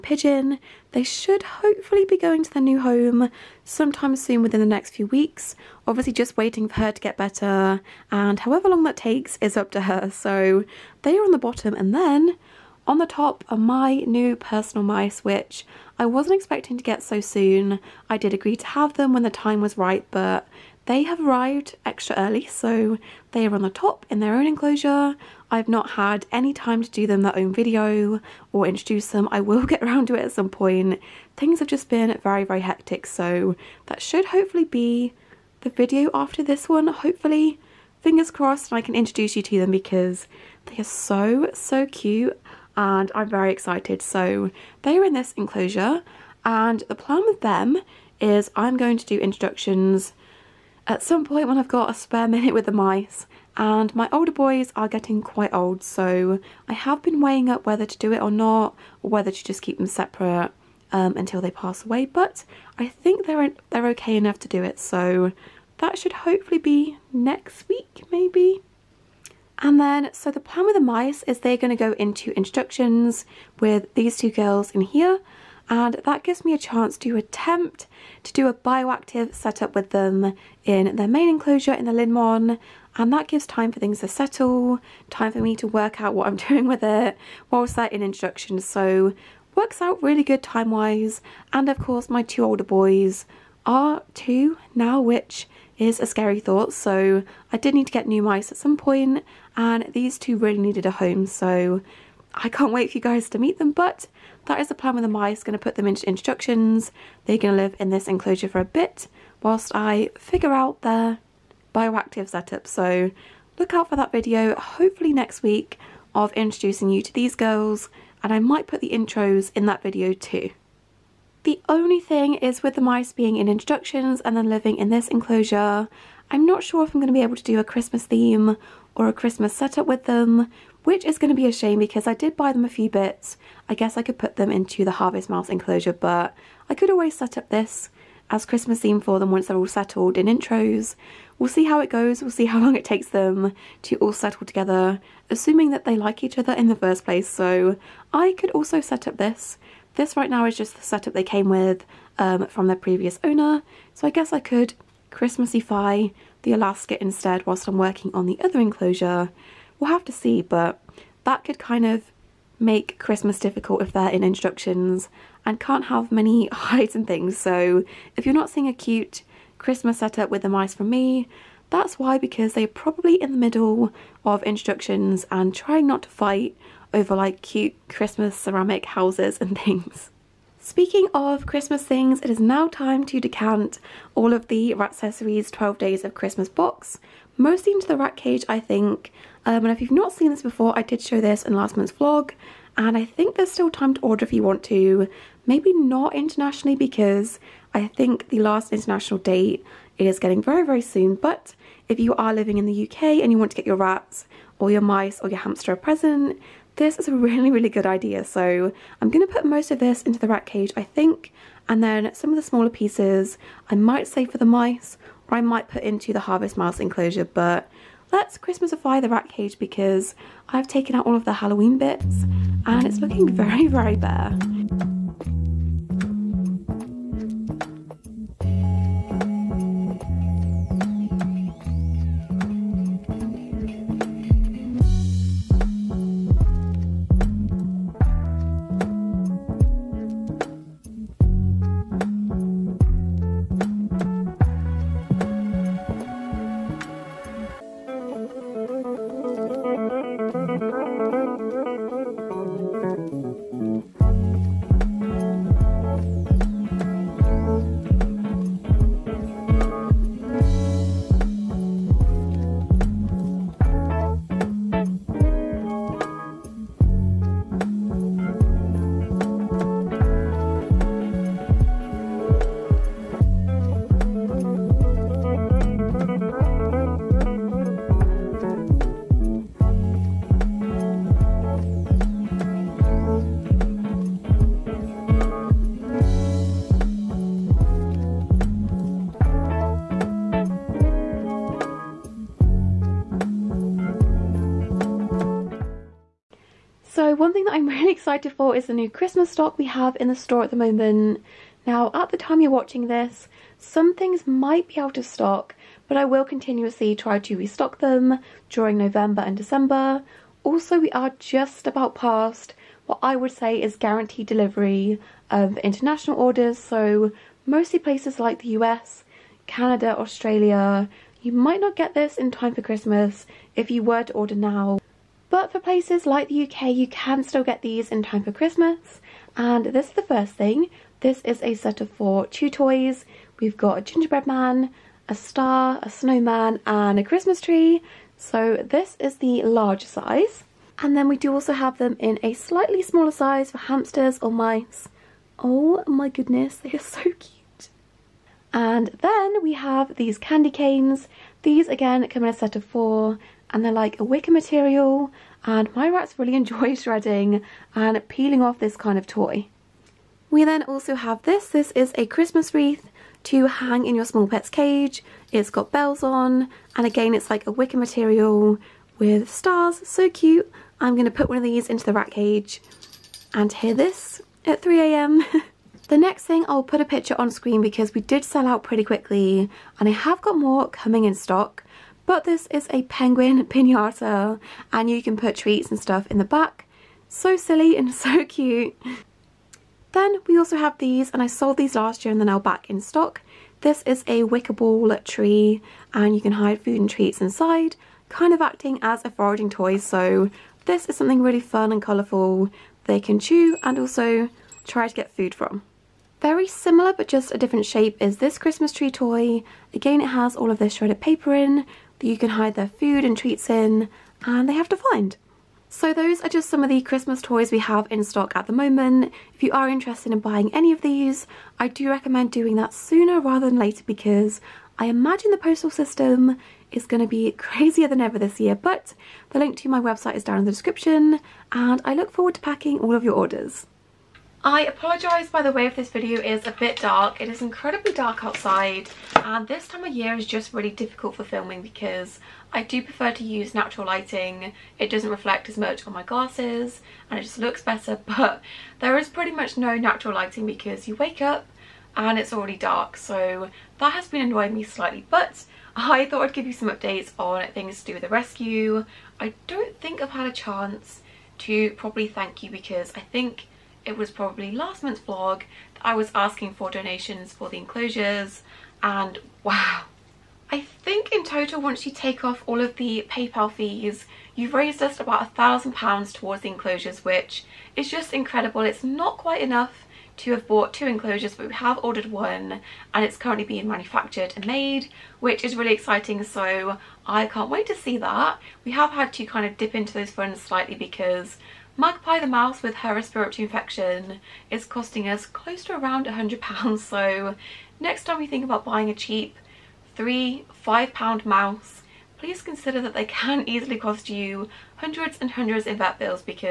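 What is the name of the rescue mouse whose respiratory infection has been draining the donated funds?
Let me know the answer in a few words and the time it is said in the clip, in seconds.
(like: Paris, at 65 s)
Magpie, at 491 s.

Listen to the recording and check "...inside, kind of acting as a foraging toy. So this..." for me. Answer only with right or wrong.
right.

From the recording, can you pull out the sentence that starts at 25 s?
I've not had any time to do them their own video or introduce them.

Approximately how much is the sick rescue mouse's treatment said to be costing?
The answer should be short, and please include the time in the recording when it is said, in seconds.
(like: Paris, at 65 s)
£100, at 496 s.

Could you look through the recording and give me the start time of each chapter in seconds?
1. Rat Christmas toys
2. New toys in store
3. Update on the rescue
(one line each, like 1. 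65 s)
1. 180 s
2. 296 s
3. 434 s.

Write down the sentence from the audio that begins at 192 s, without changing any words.
And I think there's still time to order if you want to.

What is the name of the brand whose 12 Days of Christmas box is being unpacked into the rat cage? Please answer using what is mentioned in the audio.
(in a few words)
Ratcessories.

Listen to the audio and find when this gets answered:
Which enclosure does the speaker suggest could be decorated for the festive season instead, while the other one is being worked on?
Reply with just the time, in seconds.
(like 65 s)
156 s.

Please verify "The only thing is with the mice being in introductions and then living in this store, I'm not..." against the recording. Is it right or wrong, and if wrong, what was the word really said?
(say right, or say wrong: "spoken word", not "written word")
wrong: "enclosure", not "store".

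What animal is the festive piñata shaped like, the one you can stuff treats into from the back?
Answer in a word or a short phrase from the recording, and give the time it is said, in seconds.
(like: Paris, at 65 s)
penguin, at 382 s.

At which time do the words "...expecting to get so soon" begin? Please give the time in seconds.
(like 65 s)
16 s.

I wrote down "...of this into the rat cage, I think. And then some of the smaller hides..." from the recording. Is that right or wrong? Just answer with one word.
wrong.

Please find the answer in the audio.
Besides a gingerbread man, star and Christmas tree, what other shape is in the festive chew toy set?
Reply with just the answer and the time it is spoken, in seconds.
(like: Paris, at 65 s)
snowman, at 335 s.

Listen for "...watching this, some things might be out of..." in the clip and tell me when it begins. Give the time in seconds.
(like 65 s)
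302 s.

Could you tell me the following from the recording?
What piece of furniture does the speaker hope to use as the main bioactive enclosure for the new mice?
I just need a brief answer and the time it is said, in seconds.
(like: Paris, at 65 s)
Linnmon, at 81 s.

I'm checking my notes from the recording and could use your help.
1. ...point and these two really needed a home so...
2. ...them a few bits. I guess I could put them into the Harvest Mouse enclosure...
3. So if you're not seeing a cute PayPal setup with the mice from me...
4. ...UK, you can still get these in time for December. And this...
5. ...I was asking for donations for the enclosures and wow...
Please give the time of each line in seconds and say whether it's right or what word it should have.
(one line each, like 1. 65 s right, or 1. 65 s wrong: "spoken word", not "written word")
1. 98 s right
2. 132 s right
3. 167 s wrong: "Christmas", not "PayPal"
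4. 326 s wrong: "Christmas", not "December"
5. 465 s right.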